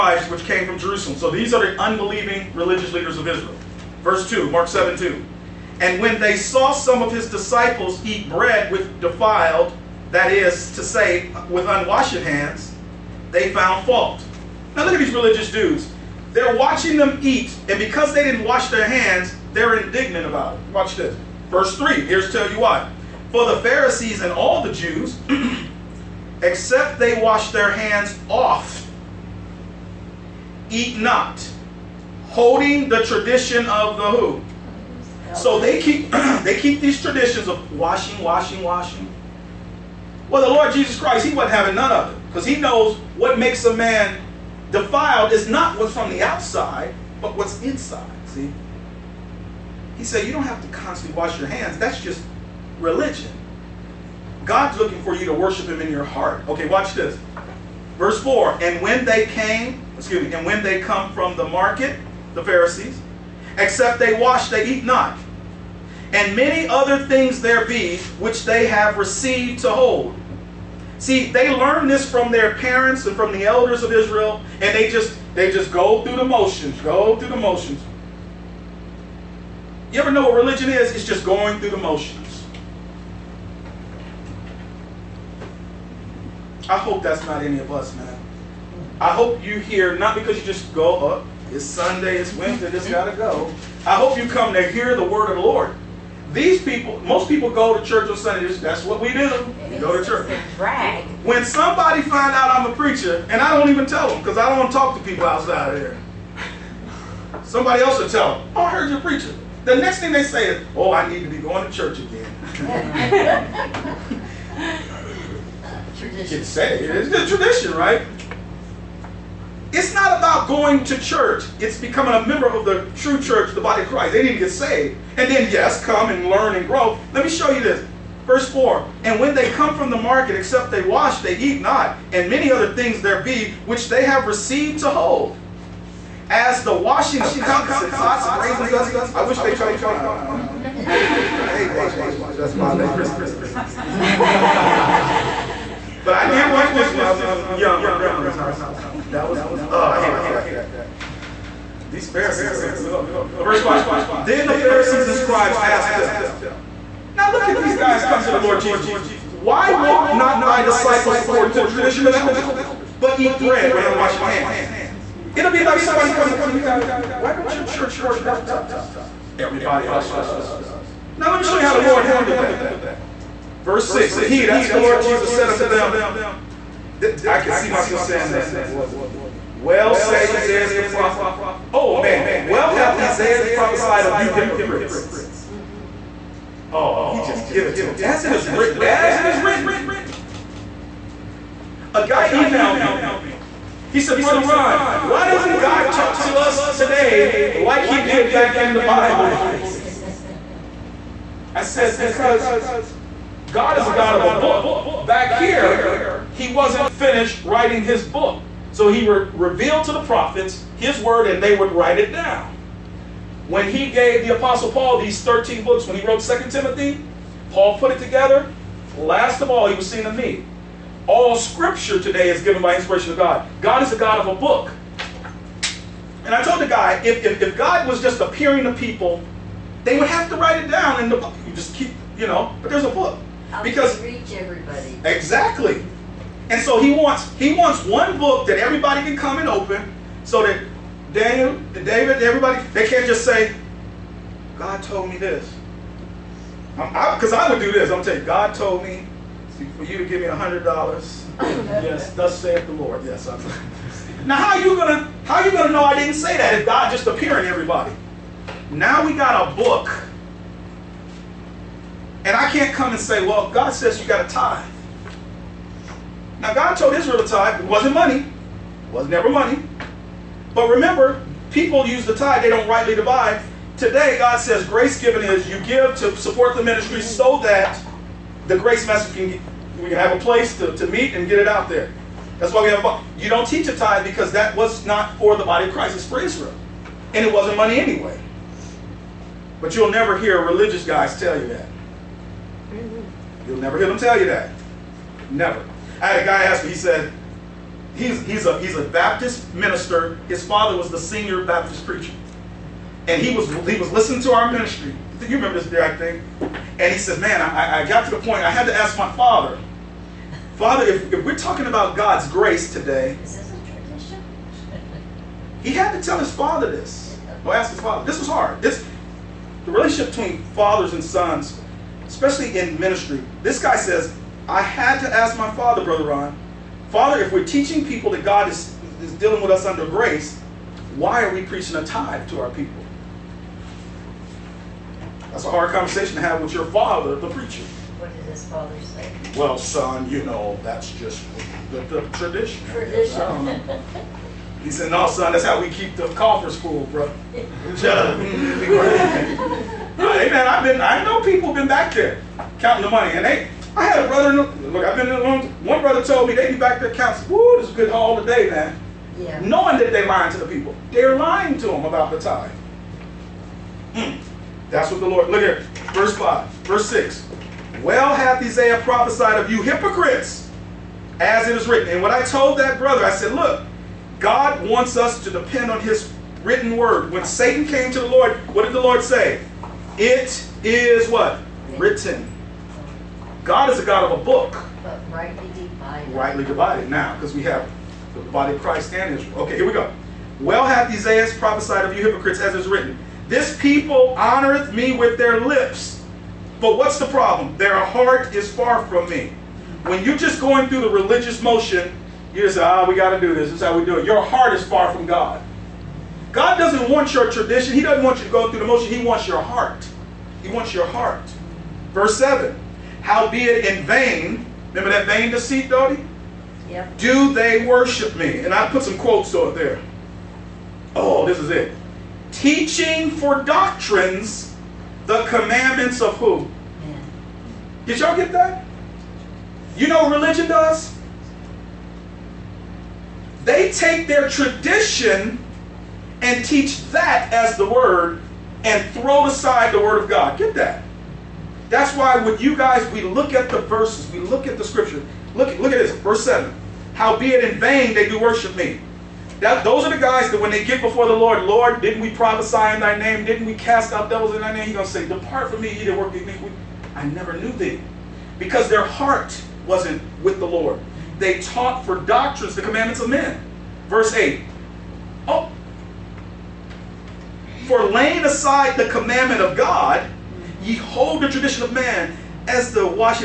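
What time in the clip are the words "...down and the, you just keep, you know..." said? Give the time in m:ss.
3:50.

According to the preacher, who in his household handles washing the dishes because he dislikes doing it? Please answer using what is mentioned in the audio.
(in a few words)
Krista.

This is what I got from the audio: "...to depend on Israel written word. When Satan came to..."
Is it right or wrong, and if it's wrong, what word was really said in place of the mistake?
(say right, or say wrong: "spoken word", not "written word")
wrong: "His", not "Israel".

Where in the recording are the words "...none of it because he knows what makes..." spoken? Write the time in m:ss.
0:41.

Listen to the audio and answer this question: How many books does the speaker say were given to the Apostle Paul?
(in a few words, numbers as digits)
13.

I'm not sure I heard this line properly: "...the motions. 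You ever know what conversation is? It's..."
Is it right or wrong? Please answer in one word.
wrong.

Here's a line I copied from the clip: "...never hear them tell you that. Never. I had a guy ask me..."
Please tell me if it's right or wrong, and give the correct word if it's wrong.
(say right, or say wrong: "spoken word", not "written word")
right.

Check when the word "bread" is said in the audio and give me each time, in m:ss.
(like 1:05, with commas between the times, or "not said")
0:08, 2:43.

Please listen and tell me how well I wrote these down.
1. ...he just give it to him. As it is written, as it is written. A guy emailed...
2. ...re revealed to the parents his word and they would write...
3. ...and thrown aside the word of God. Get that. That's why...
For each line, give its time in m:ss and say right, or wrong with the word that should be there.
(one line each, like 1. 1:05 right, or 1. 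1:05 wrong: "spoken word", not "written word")
1. 3:07 right
2. 3:29 wrong: "prophets", not "parents"
3. 7:18 right.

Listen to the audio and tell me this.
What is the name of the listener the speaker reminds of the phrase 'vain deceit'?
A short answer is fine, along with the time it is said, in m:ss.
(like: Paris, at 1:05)
Dottie, at 6:55.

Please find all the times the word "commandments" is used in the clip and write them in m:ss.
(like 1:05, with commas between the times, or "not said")
7:05, 7:42, 7:48.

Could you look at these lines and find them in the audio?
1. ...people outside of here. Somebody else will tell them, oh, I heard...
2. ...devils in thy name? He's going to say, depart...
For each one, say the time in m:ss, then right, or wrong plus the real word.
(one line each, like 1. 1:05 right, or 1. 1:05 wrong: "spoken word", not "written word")
1. 1:45 right
2. 7:34 right.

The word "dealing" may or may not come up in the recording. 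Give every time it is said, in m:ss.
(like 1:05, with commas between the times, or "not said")
5:29.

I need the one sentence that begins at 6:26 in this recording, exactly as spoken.
Now, because we have the body of Christ and Israel.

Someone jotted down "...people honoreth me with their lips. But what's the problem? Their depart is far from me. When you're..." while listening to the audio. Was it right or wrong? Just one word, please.
wrong.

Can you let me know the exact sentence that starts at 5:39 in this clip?
Well, son, you know, that's just the, the tradition.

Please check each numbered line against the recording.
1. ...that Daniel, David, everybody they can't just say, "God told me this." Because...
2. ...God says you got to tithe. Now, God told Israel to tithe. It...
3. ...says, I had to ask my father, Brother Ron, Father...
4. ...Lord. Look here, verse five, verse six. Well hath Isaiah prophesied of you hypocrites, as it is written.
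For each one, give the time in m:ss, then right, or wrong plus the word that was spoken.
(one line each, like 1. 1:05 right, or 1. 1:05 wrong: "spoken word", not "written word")
1. 4:00 right
2. 4:23 right
3. 5:23 right
4. 6:05 right.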